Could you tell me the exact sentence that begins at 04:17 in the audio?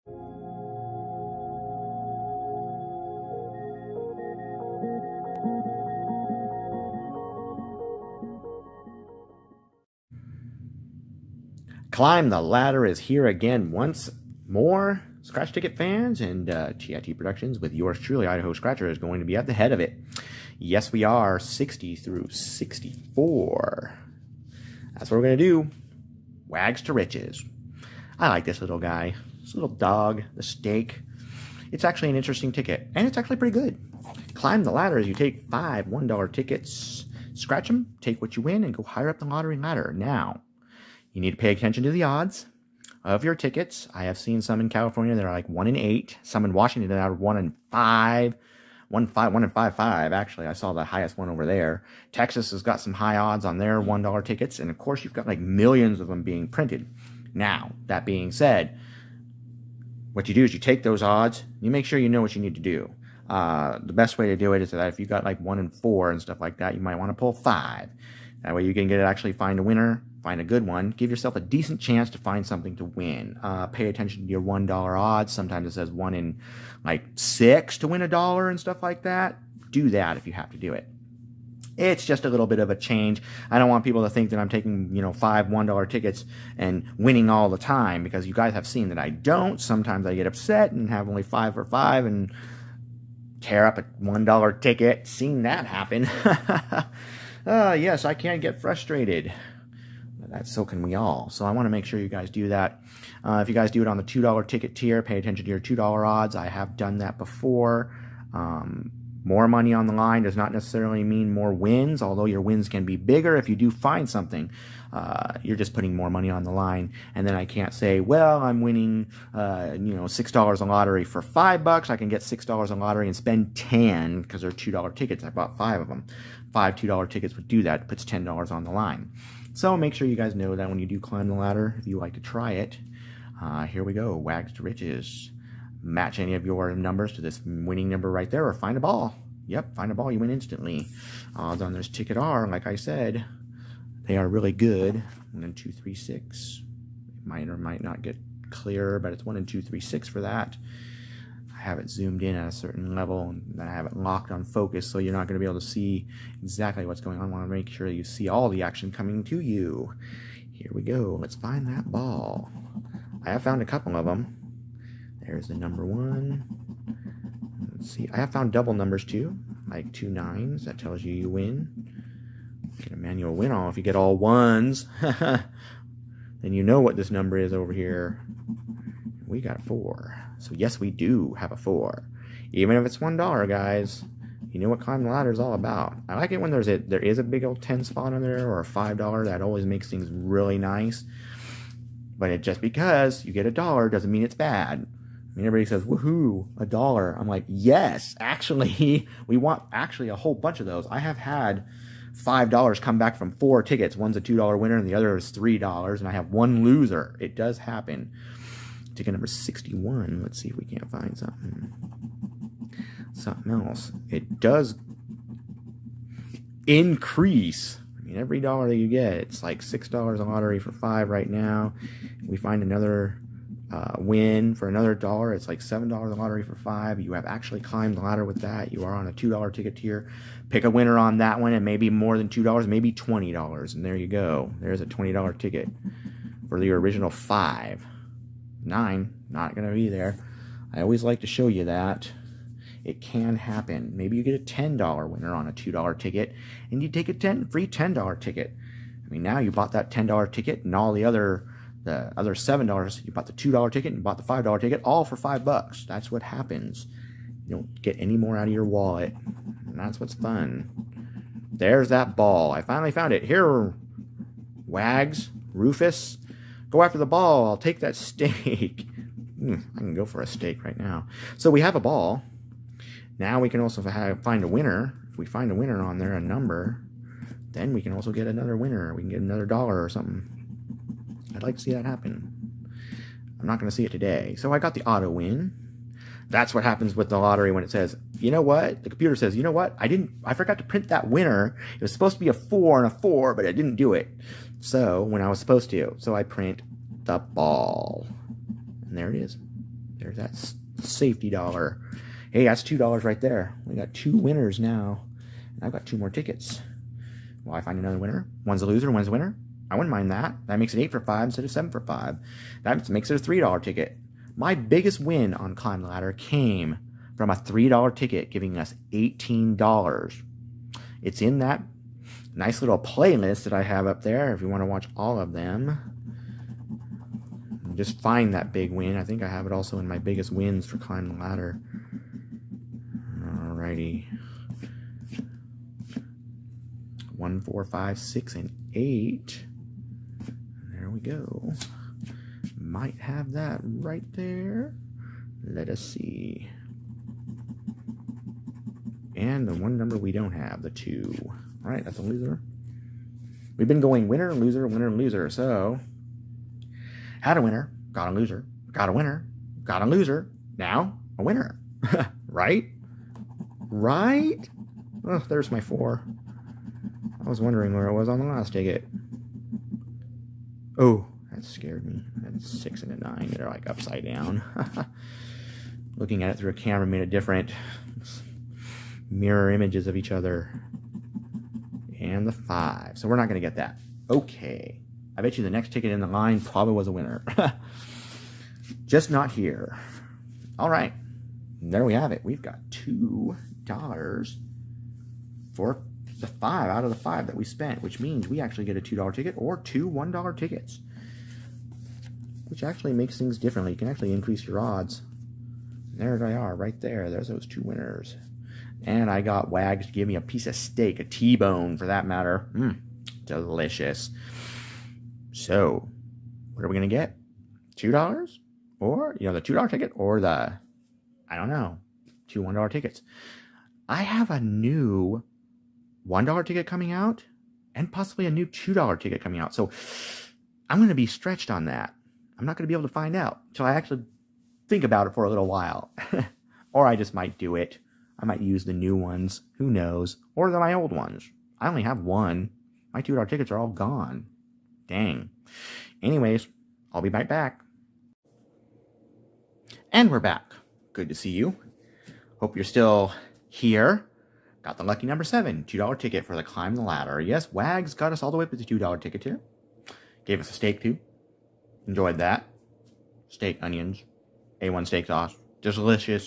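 You don't get any more out of your wallet.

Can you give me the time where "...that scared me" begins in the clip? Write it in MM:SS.
06:11.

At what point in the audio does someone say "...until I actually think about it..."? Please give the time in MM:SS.
07:13.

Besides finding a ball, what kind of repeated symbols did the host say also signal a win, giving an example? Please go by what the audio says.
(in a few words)
two nines.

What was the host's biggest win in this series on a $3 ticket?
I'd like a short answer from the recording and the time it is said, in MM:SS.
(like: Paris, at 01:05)
$18, at 05:18.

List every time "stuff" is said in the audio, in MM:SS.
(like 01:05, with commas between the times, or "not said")
01:06, 01:18.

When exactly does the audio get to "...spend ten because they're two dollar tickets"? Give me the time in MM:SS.
02:03.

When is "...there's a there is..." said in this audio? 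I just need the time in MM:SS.
03:06.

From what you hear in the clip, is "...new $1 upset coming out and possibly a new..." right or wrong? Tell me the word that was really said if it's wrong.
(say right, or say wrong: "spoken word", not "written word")
wrong: "ticket", not "upset".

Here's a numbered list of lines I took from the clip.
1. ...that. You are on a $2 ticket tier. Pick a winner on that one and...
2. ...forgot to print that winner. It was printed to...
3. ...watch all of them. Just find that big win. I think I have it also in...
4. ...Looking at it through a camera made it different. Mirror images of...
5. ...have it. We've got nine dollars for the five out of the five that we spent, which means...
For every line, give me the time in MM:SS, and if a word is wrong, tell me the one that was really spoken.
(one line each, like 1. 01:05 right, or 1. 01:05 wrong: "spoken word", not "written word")
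1. 03:48 right
2. 04:50 wrong: "supposed", not "printed"
3. 05:24 right
4. 06:15 right
5. 06:31 wrong: "two", not "nine".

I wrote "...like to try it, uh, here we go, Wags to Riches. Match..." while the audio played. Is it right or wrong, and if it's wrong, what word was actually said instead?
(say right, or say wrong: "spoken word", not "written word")
right.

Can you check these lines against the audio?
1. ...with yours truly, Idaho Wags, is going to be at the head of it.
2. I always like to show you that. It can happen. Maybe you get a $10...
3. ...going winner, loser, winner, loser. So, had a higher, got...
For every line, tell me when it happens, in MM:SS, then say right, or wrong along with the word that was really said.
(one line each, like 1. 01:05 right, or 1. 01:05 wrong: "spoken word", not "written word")
1. 00:17 wrong: "Scratcher", not "Wags"
2. 04:00 right
3. 05:53 wrong: "winner", not "higher".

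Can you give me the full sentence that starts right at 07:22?
My $2 tickets are all gone.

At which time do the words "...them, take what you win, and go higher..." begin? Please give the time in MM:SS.
00:37.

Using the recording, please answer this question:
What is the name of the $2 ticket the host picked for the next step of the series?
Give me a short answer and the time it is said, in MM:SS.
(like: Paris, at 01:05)
Lucky Number Seven, at 07:34.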